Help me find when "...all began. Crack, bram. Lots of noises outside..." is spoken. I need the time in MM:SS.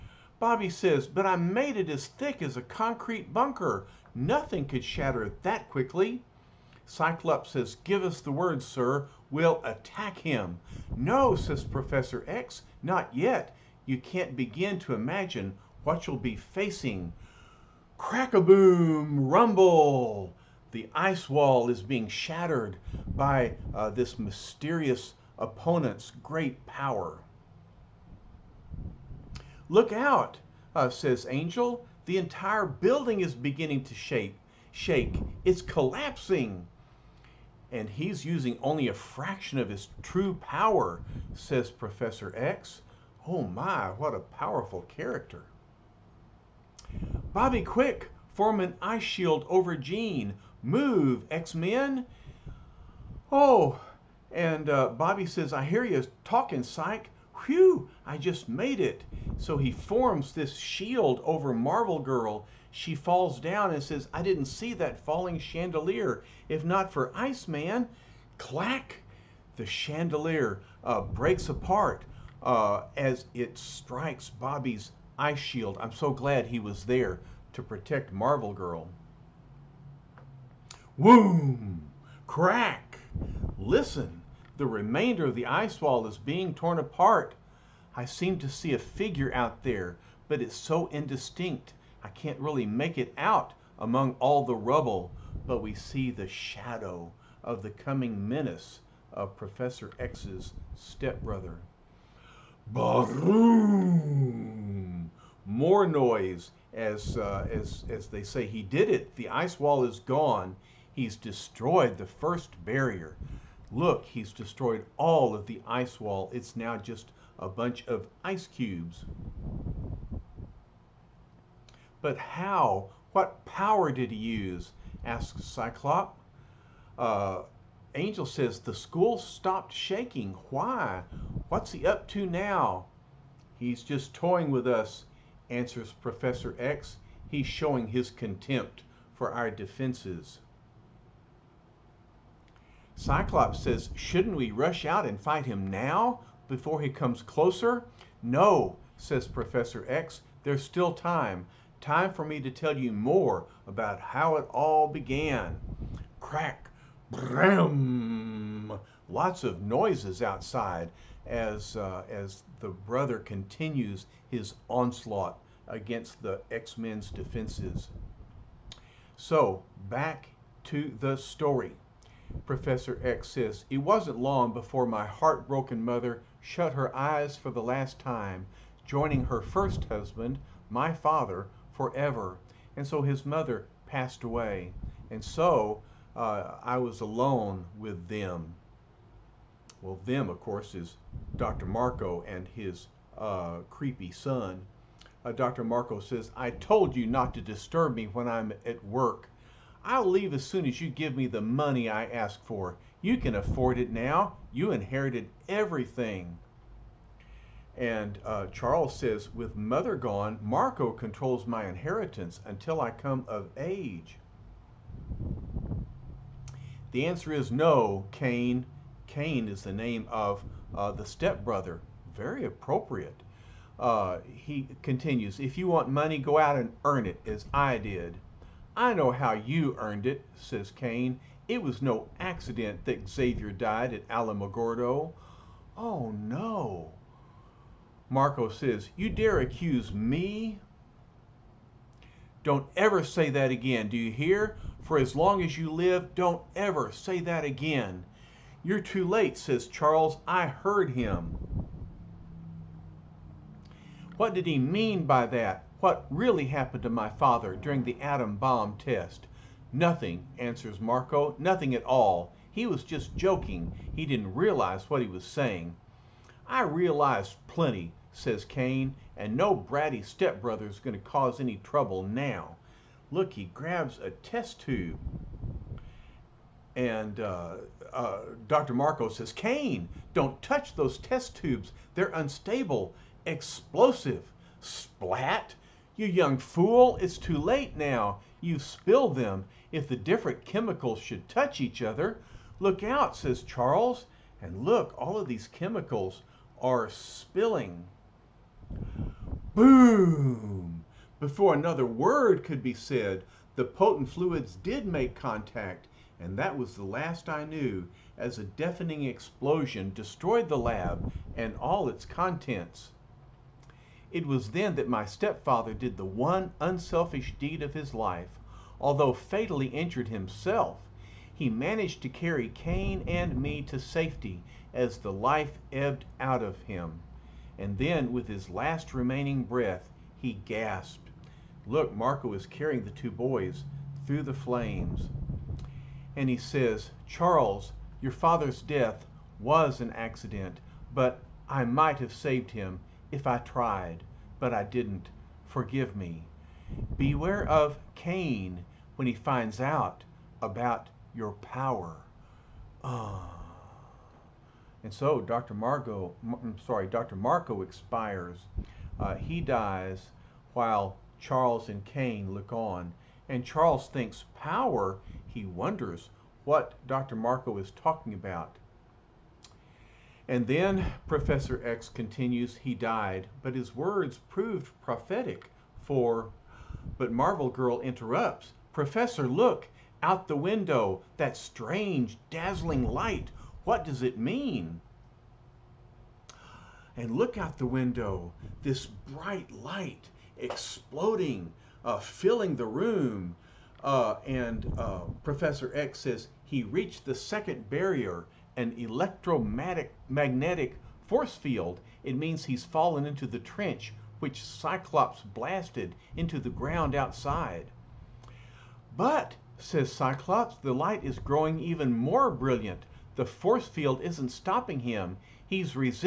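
02:34.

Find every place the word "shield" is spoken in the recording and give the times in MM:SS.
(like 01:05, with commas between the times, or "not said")
00:49, 01:00, 01:15.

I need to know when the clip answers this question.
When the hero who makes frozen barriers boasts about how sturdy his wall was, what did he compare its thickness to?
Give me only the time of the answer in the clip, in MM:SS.
00:02.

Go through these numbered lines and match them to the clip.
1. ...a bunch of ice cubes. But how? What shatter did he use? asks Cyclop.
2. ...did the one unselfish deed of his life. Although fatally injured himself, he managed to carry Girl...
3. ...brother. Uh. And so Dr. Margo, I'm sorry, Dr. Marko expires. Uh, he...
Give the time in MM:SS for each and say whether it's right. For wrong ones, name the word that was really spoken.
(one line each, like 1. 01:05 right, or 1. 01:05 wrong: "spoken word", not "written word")
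1. 01:57 wrong: "power", not "shatter"
2. 05:15 wrong: "Cain", not "Girl"
3. 05:51 wrong: "power", not "brother".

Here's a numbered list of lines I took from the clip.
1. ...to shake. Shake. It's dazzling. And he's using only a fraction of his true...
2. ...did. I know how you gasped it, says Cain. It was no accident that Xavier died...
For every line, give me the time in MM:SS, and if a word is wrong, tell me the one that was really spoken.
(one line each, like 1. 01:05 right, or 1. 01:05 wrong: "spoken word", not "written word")
1. 00:33 wrong: "collapsing", not "dazzling"
2. 03:47 wrong: "earned", not "gasped".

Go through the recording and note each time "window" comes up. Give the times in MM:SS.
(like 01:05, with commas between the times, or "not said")
06:20, 06:27.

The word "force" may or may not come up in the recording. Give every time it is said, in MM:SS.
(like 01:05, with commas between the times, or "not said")
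06:41, 06:53.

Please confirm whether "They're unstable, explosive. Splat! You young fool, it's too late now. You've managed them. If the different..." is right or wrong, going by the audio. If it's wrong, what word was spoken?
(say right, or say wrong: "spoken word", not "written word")
wrong: "spilled", not "managed".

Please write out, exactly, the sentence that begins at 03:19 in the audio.
I'll leave as soon as you give me the money I ask for.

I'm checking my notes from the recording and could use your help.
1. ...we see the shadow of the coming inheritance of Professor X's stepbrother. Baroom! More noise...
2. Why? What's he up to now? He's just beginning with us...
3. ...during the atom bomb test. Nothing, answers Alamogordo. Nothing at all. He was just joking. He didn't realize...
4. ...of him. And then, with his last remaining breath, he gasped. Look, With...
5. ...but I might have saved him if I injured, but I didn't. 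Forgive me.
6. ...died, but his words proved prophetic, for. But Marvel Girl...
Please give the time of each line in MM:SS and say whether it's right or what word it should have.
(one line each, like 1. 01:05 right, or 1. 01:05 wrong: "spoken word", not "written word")
1. 01:35 wrong: "menace", not "inheritance"
2. 02:10 wrong: "toying", not "beginning"
3. 04:17 wrong: "Marko", not "Alamogordo"
4. 05:26 wrong: "Marko", not "With"
5. 05:40 wrong: "tried", not "injured"
6. 06:12 right.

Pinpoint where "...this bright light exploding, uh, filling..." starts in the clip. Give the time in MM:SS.
06:28.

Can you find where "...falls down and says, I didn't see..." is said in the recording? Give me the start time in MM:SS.
01:02.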